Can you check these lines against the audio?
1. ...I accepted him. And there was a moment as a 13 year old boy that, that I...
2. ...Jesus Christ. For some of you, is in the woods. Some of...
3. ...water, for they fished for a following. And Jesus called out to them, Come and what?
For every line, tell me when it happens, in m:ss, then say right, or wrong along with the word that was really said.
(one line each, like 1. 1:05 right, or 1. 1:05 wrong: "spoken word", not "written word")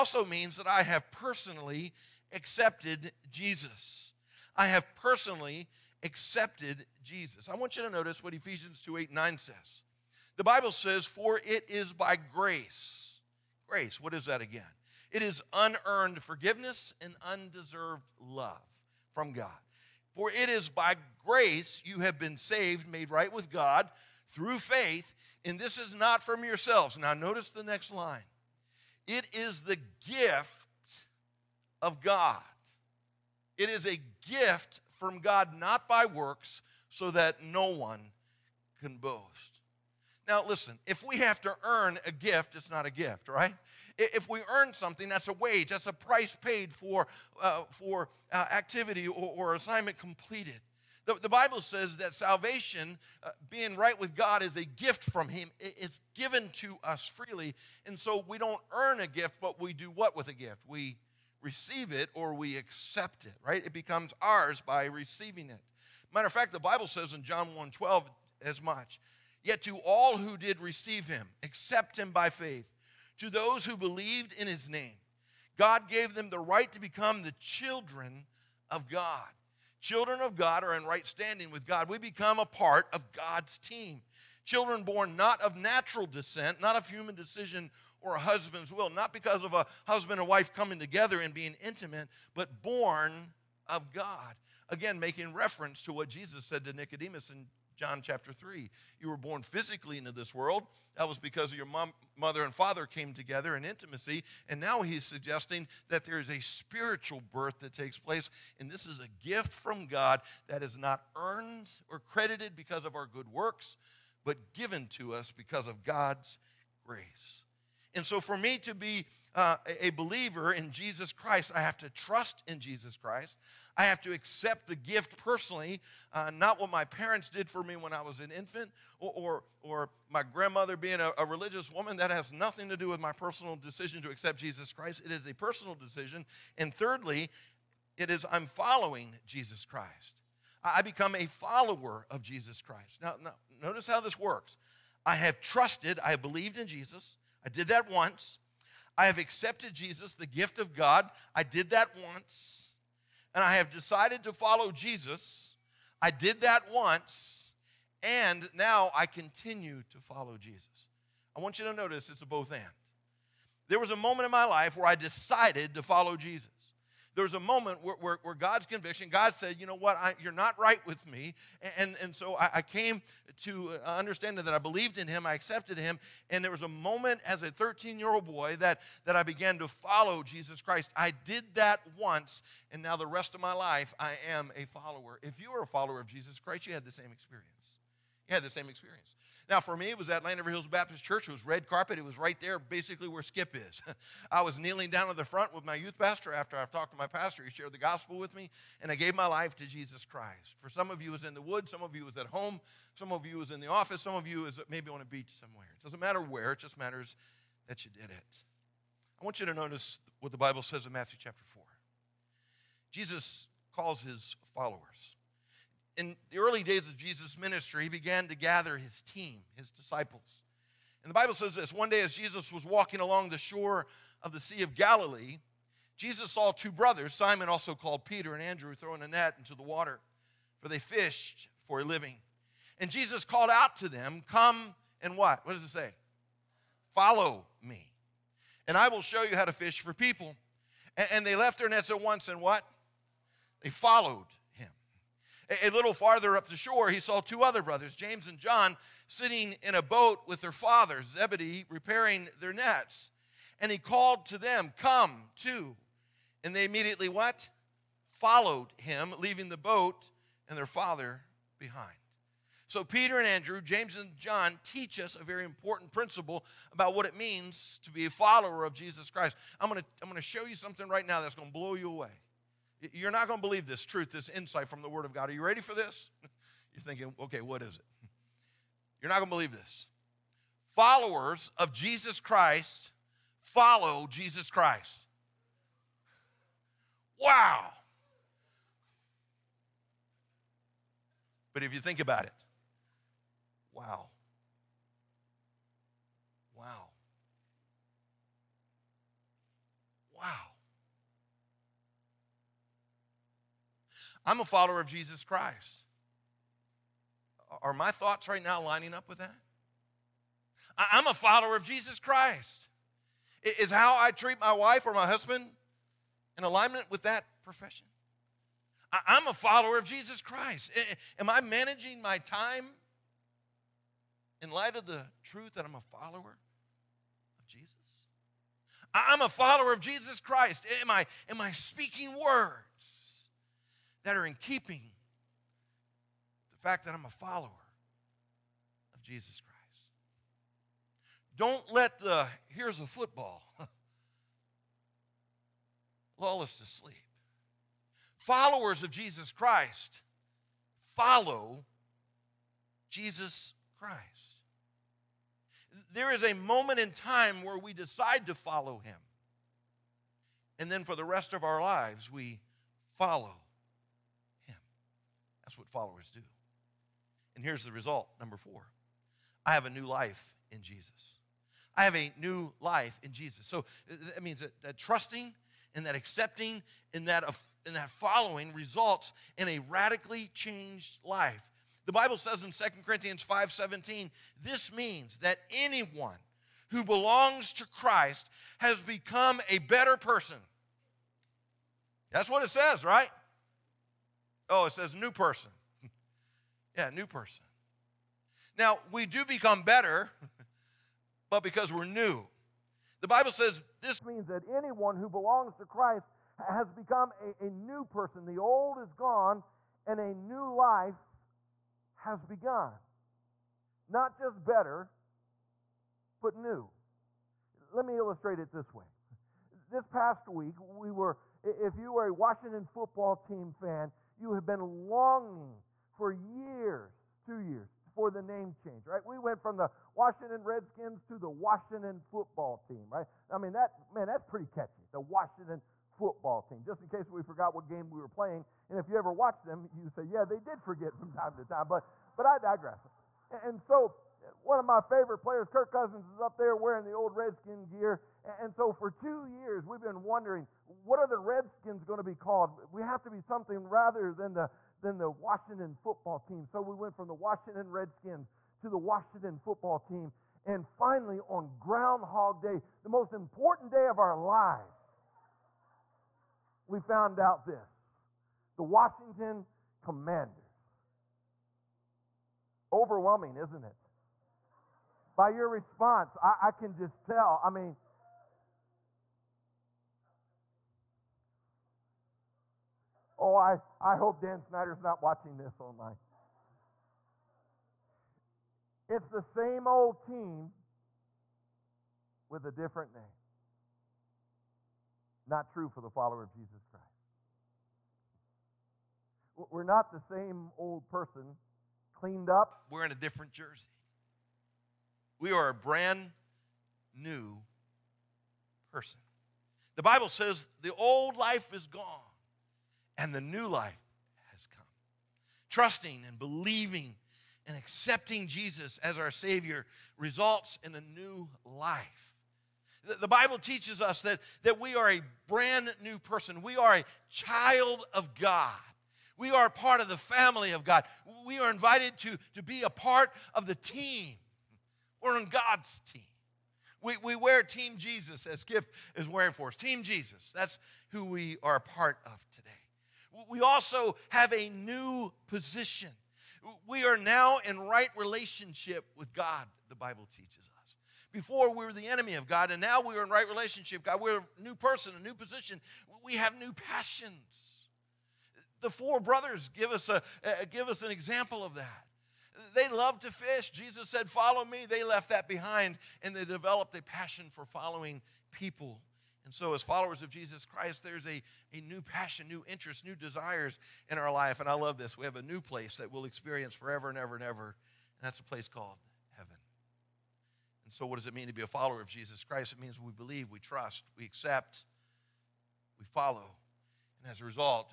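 1. 2:55 right
2. 3:19 right
3. 3:49 wrong: "living", not "following".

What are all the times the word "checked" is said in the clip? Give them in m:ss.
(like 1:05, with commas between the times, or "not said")
not said.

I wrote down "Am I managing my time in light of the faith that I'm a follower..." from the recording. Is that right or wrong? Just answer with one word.
wrong.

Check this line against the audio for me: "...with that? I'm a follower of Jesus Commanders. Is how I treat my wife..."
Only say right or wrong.
wrong.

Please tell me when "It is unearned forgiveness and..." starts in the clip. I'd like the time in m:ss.
0:15.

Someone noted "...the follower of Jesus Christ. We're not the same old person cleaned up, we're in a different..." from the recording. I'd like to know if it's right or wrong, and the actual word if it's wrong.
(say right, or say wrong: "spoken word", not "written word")
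right.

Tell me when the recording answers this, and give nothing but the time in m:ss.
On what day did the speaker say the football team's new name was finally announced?
7:41.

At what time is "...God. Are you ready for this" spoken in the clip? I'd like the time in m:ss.
4:35.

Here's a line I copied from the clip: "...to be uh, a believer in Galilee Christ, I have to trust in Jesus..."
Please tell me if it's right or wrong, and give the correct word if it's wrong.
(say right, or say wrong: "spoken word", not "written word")
wrong: "Jesus", not "Galilee".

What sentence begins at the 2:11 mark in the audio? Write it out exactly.
That has nothing to do with my personal decision to accept Jesus Christ.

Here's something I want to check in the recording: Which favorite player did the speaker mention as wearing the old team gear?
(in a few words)
Kirk Cousins.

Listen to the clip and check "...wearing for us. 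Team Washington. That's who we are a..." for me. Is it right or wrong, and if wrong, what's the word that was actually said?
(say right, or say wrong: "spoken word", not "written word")
wrong: "Jesus", not "Washington".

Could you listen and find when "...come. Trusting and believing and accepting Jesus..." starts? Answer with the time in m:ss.
8:34.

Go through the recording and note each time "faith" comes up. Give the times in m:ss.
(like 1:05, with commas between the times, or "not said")
0:24, 1:12.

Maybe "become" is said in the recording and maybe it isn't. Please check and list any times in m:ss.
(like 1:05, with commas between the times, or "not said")
1:03, 1:16, 1:21, 2:20, 6:28, 6:39, 6:46.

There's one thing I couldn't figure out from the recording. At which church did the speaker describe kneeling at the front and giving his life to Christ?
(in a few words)
Landover Hills Baptist Church.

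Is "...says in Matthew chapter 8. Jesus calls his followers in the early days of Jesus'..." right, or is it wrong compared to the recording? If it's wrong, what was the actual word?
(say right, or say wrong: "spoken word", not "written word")
wrong: "4", not "8".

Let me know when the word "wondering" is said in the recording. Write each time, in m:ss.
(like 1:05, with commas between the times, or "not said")
7:30.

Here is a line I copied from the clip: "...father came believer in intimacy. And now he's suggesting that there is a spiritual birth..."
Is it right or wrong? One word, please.
wrong.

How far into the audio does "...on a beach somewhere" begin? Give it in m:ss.
3:24.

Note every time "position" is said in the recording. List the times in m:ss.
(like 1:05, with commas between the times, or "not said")
9:05, 9:15.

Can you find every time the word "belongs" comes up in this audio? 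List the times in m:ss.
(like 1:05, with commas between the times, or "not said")
6:26, 6:45.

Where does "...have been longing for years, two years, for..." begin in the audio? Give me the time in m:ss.
7:04.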